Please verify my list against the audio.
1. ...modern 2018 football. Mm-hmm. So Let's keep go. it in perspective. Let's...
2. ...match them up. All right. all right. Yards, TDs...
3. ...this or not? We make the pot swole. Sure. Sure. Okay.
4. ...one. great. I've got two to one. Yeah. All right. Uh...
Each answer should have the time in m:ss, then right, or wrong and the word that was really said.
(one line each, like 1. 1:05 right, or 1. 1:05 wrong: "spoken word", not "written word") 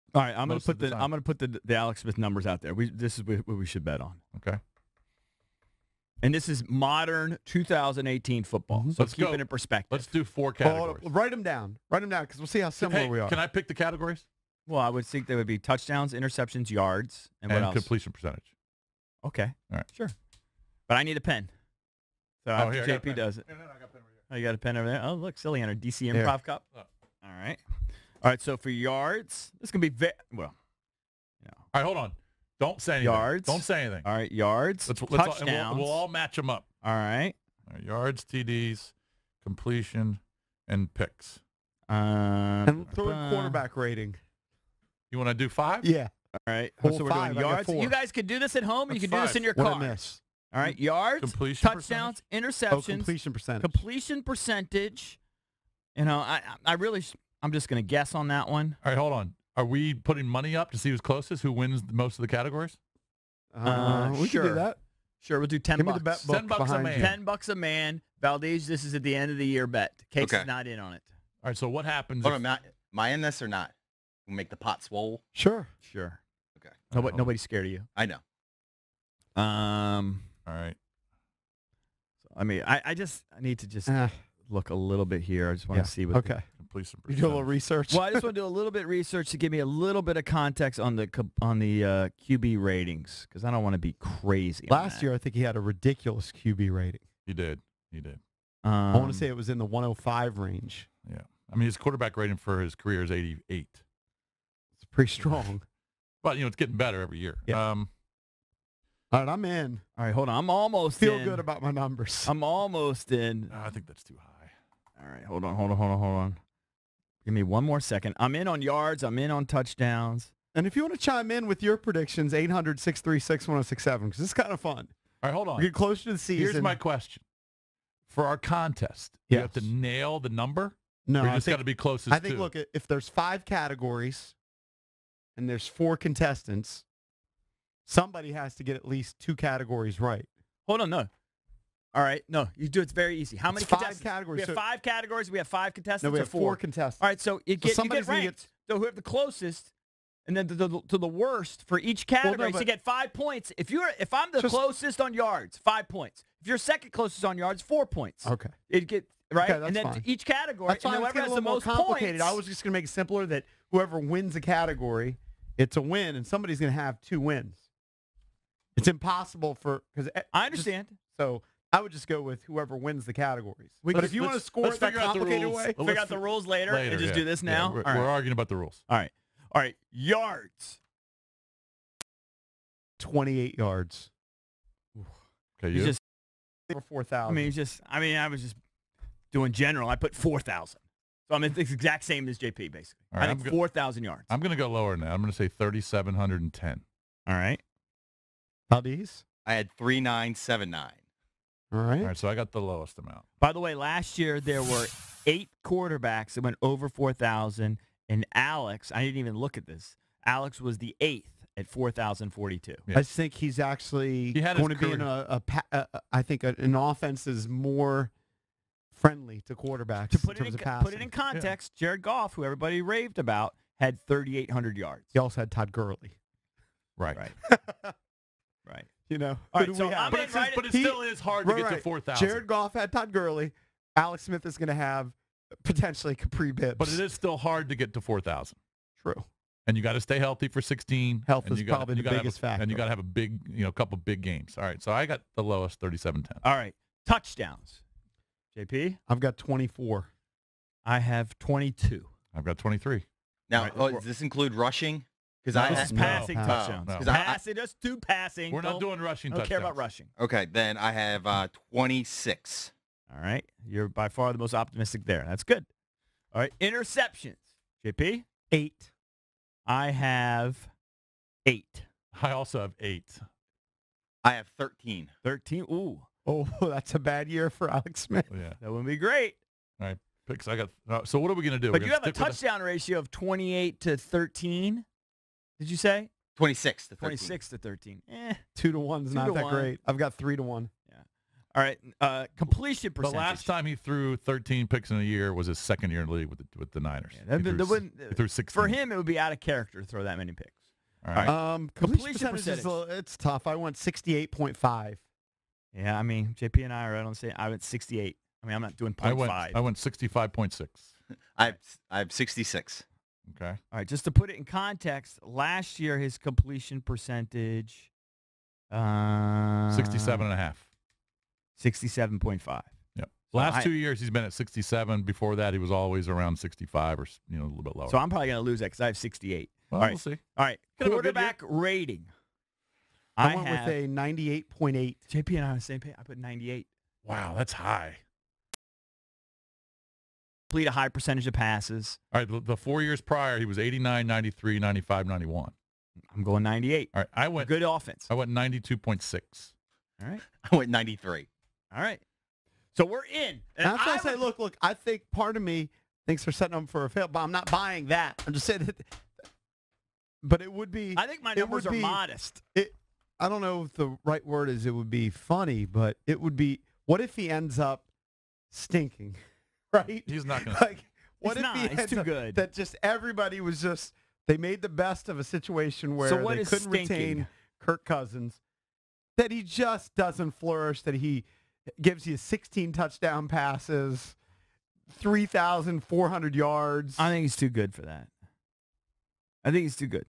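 1. 0:06 right
2. 0:36 right
3. 1:13 right
4. 4:49 wrong: "three", not "two".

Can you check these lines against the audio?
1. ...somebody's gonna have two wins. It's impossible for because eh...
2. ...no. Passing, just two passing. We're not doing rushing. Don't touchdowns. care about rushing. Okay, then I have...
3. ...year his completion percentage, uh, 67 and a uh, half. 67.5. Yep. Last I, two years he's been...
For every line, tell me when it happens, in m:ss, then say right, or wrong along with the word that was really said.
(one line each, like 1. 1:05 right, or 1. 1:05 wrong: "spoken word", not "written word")
1. 2:46 right
2. 4:16 right
3. 5:15 right.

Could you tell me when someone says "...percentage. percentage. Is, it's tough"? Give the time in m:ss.
5:02.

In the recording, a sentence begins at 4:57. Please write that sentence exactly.
Yeah, that, he, threw, that he threw 16.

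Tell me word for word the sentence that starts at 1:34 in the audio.
Last year, I think he had a ridiculous QB rating.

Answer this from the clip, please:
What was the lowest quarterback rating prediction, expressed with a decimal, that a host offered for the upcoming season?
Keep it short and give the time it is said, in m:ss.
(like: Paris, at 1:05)
92.6, at 5:48.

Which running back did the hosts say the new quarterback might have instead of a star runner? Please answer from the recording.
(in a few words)
Kapri Bibbs.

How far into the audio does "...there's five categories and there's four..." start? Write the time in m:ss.
2:12.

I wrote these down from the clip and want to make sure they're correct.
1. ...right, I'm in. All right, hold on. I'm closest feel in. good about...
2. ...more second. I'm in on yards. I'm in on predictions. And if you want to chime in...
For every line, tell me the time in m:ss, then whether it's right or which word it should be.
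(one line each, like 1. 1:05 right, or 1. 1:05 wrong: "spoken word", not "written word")
1. 1:49 wrong: "almost", not "closest"
2. 1:57 wrong: "touchdowns", not "predictions".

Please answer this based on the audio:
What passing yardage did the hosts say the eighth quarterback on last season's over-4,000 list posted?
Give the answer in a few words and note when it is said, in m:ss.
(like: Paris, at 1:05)
4,042, at 3:31.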